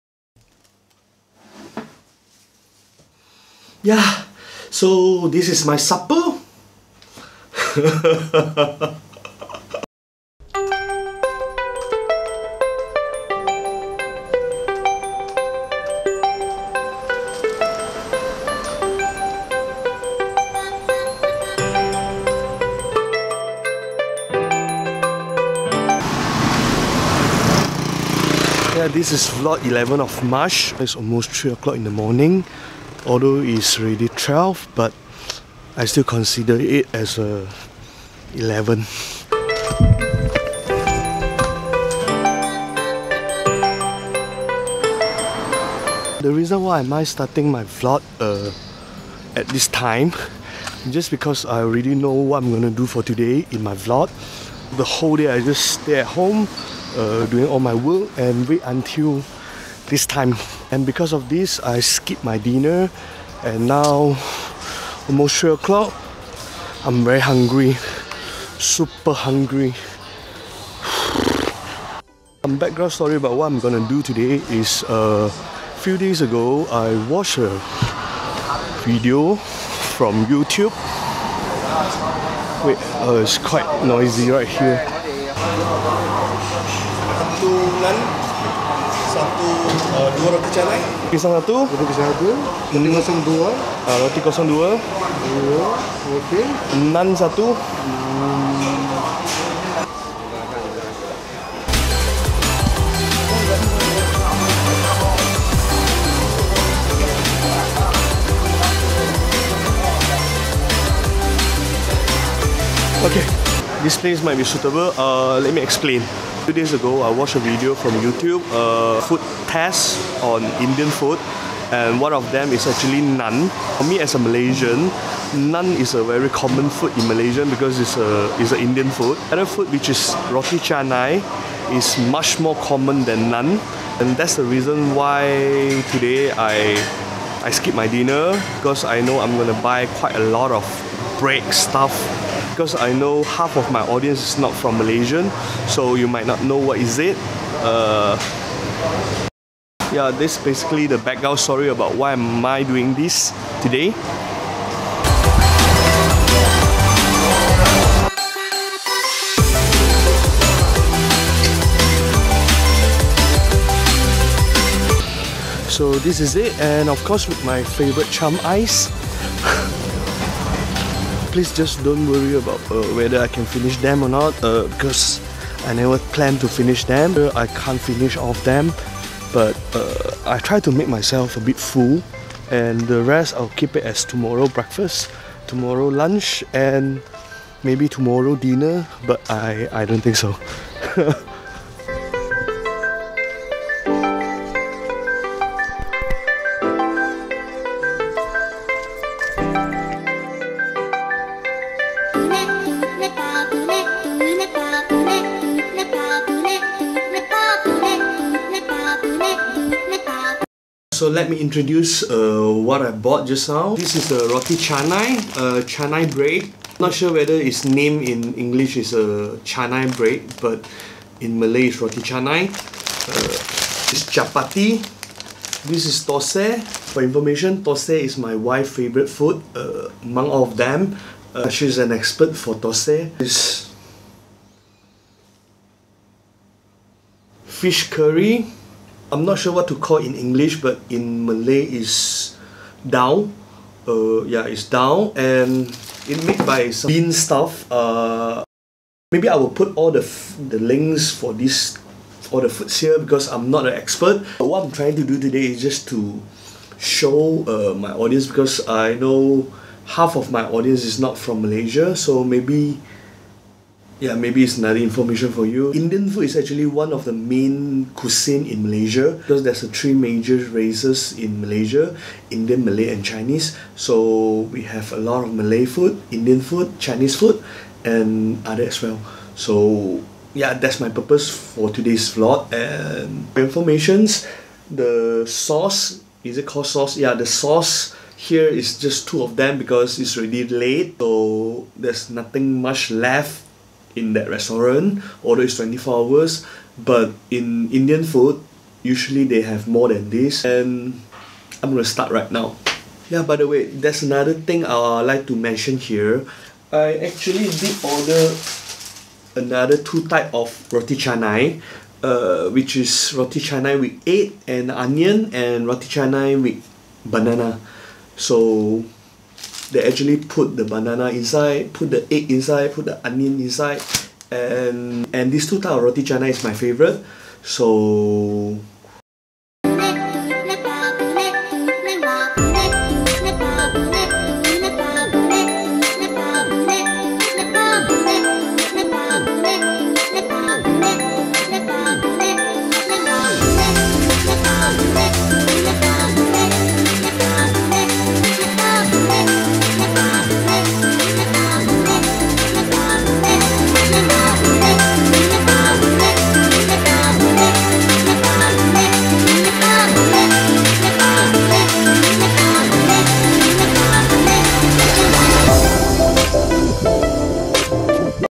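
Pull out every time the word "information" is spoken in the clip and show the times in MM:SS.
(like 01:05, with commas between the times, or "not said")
03:47, 04:24, 04:43.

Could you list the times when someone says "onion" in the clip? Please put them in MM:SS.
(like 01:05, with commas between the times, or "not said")
05:14, 05:23.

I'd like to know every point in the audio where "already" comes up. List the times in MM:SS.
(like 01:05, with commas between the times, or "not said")
00:51, 04:50.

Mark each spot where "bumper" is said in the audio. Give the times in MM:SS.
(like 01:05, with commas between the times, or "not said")
not said.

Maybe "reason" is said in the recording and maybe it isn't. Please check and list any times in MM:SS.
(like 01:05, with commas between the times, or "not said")
00:46, 02:14.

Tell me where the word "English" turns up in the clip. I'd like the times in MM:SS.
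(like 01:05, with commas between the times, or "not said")
03:38, 04:00.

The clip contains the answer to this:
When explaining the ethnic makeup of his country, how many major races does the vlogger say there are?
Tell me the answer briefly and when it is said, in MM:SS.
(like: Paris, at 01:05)
3, at 04:29.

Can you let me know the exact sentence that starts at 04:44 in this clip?
The sauce, is it called sauce?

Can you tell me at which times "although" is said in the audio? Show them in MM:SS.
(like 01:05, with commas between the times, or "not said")
00:33, 04:55.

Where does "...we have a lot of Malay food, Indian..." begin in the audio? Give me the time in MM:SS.
04:34.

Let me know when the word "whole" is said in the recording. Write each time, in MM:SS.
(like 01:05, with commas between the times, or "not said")
00:54.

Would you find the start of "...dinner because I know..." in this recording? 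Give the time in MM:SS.
02:17.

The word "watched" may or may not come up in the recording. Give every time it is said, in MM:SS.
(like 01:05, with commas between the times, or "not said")
01:17, 01:57.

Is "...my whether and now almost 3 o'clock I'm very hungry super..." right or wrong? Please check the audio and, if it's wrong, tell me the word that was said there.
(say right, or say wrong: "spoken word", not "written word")
wrong: "dinner", not "whether".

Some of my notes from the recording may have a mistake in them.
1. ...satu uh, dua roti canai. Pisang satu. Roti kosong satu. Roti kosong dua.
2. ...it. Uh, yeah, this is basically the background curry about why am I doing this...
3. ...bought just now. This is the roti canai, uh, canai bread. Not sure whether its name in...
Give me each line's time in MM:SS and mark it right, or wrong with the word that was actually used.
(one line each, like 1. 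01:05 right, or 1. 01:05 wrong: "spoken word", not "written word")
1. 01:29 wrong: "pisang", not "kosong"
2. 02:26 wrong: "story", not "curry"
3. 03:32 right.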